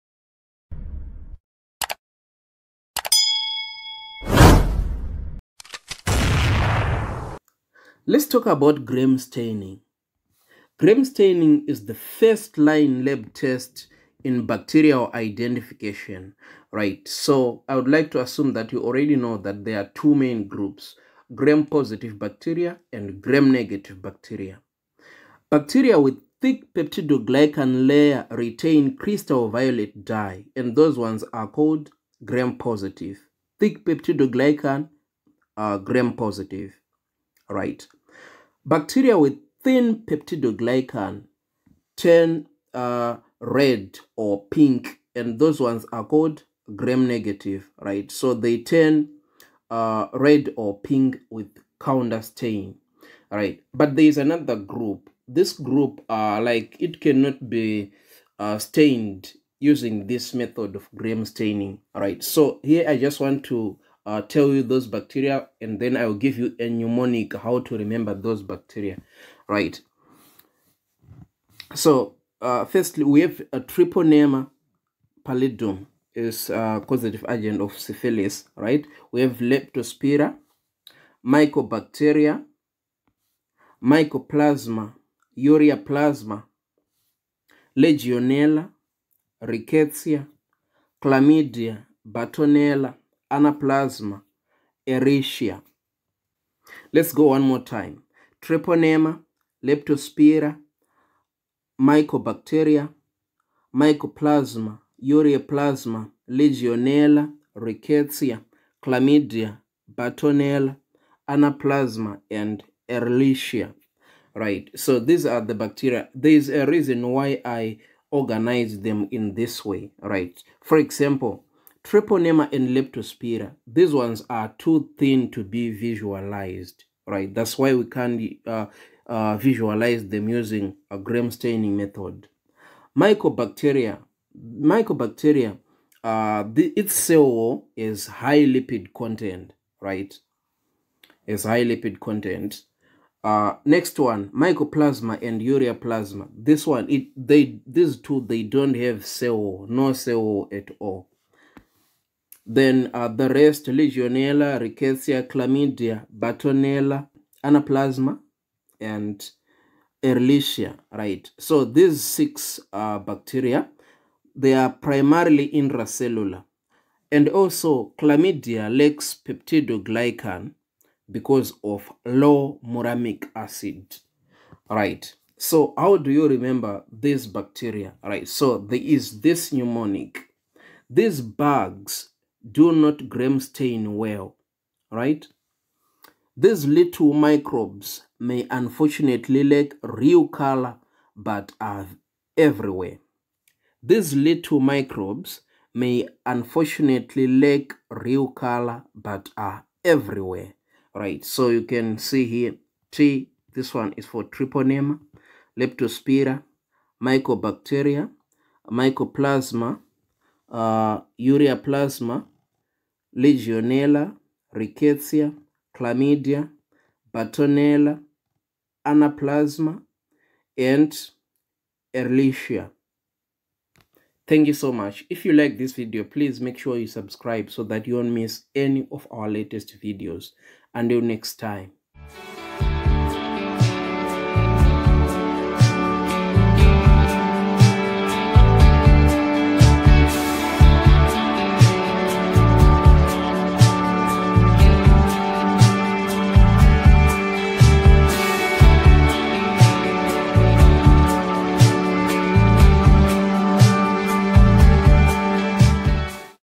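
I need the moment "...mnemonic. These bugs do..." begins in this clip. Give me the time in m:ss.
2:59.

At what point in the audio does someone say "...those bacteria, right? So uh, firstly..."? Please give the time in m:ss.
1:08.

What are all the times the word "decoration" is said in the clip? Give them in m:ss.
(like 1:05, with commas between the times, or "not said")
not said.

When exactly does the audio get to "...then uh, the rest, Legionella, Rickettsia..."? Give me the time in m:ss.
2:32.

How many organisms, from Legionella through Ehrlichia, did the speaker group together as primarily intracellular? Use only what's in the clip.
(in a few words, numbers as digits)
6.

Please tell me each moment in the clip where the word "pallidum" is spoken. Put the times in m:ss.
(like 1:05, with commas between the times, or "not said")
1:15.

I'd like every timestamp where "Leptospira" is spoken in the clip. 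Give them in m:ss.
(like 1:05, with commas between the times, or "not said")
1:19, 1:39, 2:02, 3:25.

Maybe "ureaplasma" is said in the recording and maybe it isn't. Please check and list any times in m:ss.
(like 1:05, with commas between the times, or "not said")
1:25, 1:45, 2:25, 3:31.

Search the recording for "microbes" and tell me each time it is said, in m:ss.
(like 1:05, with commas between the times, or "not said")
3:07, 3:14.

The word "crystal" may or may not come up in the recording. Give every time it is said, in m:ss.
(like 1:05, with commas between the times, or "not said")
0:28.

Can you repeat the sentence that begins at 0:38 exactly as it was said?
Bacteria with thin peptidoglycan turn uh, red or pink, and those ones are called gram negative, right?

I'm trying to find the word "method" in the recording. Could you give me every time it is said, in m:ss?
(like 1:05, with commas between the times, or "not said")
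1:00, 2:11.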